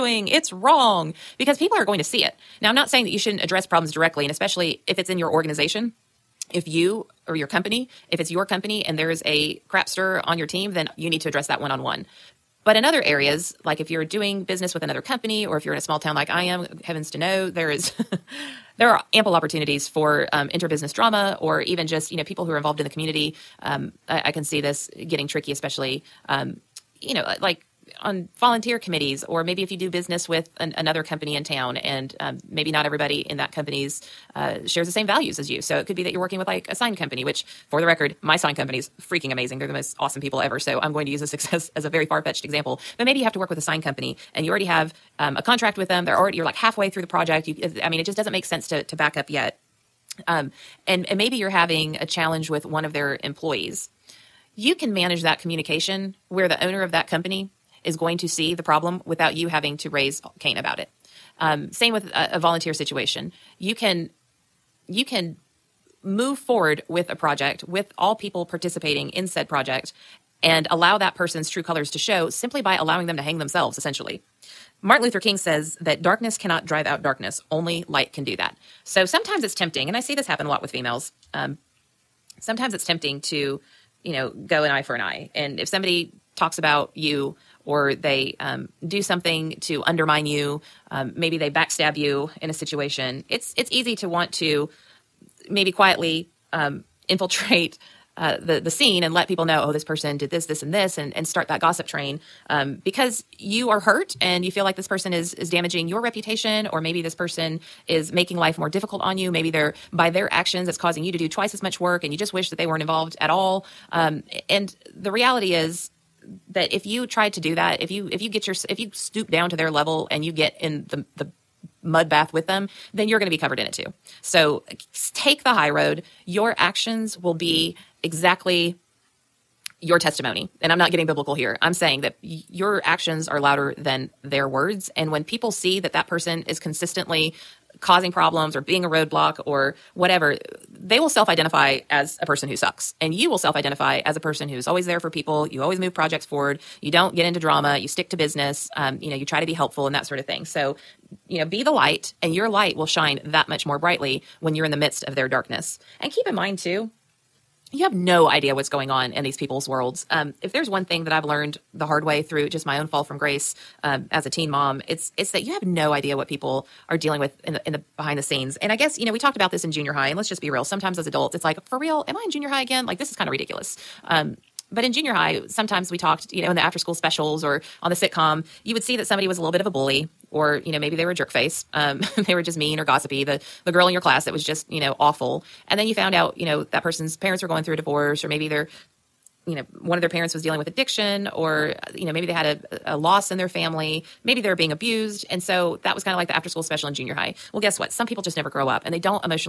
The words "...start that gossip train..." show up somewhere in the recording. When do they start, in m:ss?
1:41.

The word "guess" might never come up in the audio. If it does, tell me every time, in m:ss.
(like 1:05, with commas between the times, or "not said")
2:48, 3:17.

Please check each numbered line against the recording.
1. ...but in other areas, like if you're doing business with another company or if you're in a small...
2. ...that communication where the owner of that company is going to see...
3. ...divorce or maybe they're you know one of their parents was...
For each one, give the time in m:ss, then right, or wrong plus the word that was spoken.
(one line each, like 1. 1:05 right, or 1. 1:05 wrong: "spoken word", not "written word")
1. 0:12 right
2. 0:55 right
3. 3:07 right.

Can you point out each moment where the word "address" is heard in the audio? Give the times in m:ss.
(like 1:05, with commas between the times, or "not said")
0:03, 0:11.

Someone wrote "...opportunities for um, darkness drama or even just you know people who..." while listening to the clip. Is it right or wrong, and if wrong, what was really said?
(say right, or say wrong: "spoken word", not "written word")
wrong: "interbusiness", not "darkness".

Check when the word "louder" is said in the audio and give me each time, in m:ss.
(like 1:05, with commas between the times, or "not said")
2:13.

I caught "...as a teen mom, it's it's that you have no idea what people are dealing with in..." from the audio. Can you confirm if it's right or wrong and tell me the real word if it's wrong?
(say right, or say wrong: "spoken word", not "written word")
right.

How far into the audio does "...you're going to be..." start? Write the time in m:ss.
2:03.